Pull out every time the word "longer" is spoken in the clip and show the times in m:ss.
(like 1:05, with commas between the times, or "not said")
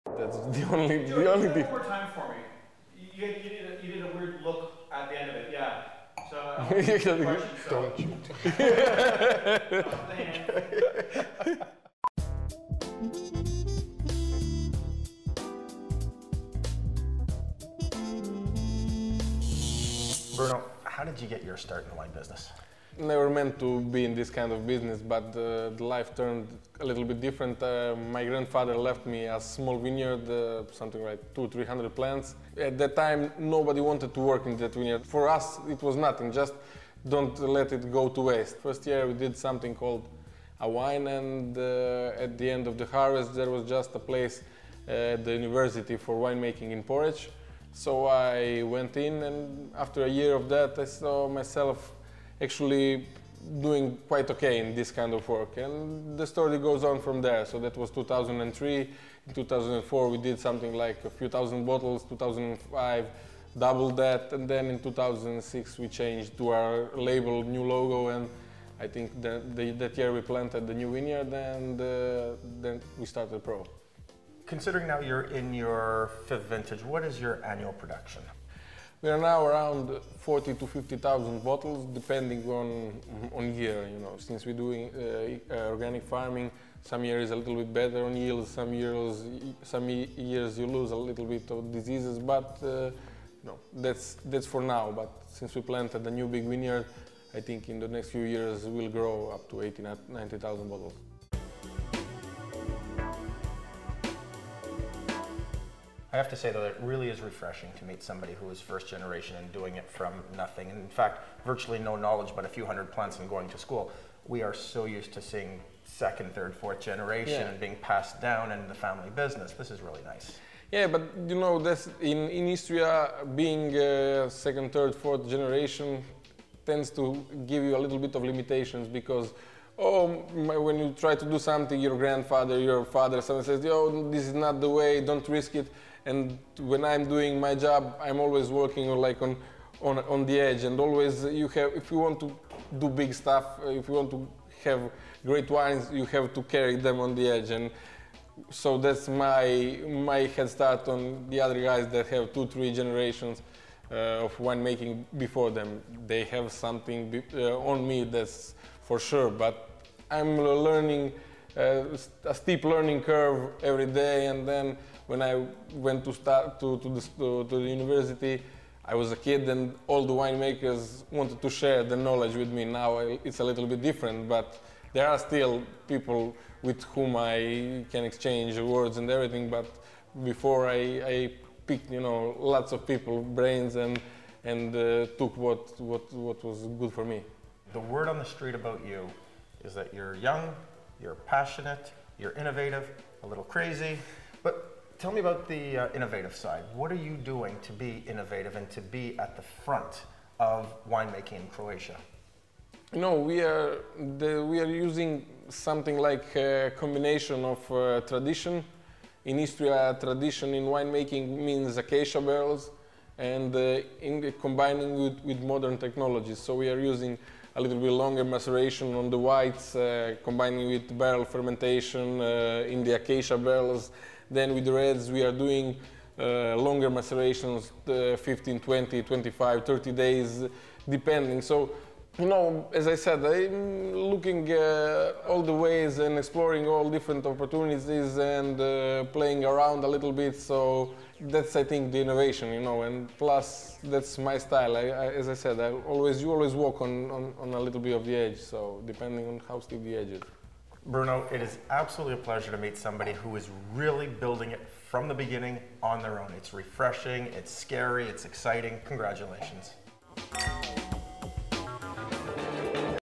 3:37, 3:46.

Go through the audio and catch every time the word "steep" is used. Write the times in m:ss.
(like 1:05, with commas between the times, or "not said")
2:42, 4:09.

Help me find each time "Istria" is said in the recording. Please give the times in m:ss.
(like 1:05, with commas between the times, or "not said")
2:02, 3:29.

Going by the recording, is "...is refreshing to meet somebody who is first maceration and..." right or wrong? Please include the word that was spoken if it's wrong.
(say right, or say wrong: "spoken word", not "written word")
wrong: "generation", not "maceration".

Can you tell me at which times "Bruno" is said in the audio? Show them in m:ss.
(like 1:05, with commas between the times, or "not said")
0:20, 4:10.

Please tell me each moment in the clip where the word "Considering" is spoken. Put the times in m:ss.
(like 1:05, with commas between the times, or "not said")
1:14.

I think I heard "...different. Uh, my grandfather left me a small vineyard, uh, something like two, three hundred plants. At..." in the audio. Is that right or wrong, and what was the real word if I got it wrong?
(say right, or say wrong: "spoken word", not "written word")
right.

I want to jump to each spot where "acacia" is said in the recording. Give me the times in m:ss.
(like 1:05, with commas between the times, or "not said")
3:31, 3:42.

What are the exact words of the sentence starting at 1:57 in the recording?
and being passed down in the family business.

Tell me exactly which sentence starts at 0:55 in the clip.
And the story goes on from there.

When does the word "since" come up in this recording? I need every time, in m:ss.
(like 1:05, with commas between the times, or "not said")
1:24, 1:35.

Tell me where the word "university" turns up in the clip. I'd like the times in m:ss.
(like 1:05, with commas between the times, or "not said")
0:45, 2:47.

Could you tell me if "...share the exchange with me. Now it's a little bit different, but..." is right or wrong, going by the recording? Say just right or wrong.
wrong.